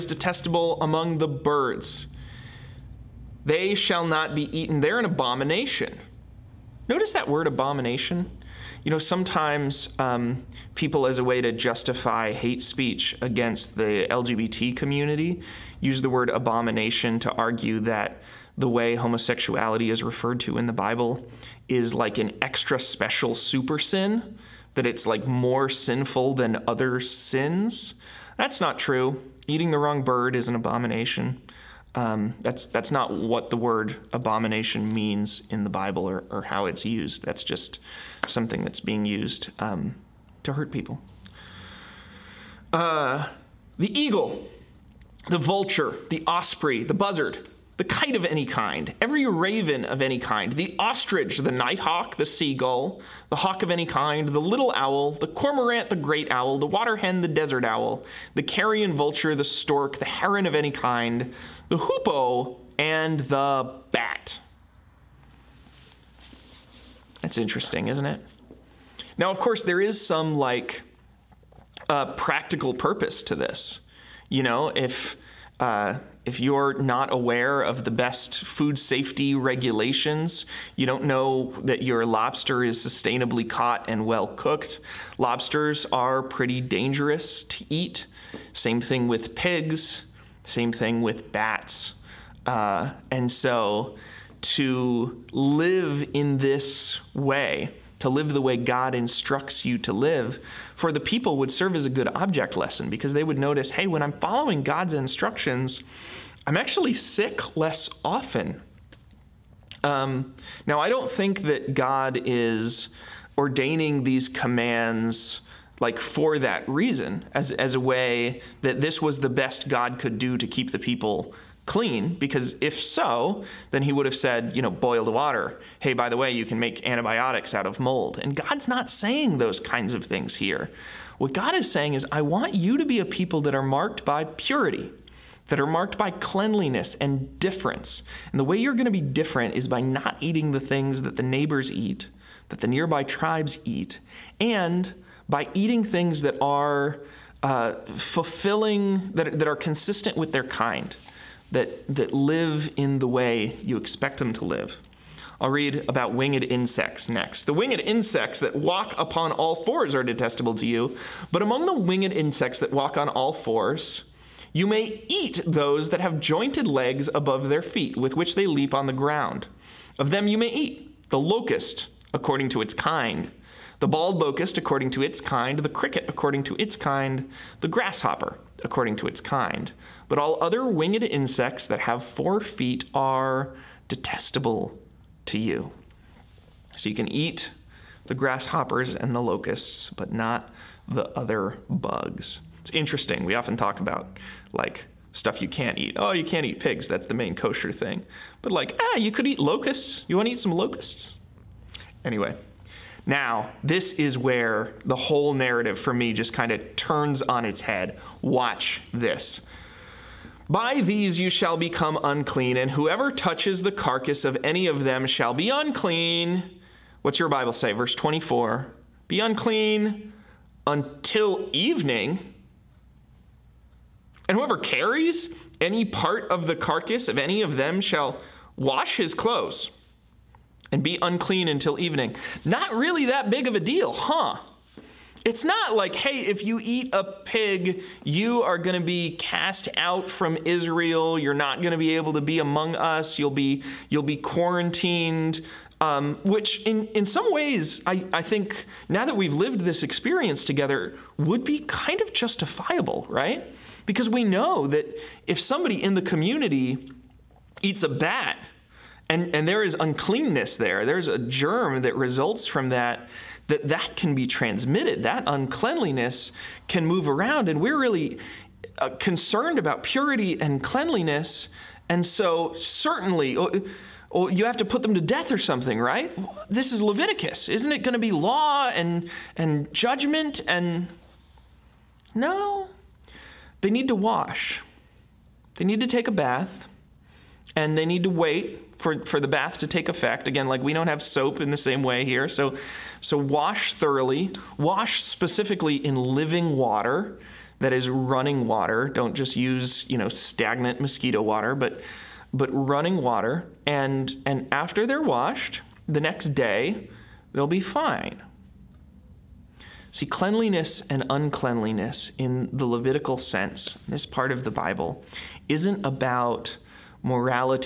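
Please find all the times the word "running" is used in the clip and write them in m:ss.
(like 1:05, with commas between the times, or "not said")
4:57, 5:02.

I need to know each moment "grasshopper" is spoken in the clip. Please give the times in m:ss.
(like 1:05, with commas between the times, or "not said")
2:57, 3:08.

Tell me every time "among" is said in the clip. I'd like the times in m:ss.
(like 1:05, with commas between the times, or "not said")
0:00, 2:41, 4:02.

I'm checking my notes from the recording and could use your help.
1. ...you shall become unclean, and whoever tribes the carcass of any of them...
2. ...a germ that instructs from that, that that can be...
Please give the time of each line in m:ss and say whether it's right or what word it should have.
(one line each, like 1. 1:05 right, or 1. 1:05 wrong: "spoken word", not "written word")
1. 3:31 wrong: "touches", not "tribes"
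2. 4:21 wrong: "results", not "instructs".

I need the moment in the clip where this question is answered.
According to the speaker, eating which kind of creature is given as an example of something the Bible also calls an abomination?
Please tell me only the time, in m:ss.
0:29.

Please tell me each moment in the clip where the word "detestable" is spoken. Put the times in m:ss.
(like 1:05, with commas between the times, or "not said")
0:00, 2:40, 3:03.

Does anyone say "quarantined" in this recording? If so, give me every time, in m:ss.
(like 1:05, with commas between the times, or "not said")
4:04.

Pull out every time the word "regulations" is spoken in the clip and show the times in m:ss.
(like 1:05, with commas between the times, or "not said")
1:19.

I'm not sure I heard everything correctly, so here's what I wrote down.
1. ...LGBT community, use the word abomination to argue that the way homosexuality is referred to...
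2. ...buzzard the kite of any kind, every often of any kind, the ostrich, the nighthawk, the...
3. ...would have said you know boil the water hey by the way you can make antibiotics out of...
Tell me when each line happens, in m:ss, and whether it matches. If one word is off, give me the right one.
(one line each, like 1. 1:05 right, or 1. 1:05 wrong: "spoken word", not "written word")
1. 0:14 right
2. 0:46 wrong: "raven", not "often"
3. 2:03 right.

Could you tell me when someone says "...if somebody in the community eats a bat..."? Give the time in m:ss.
4:15.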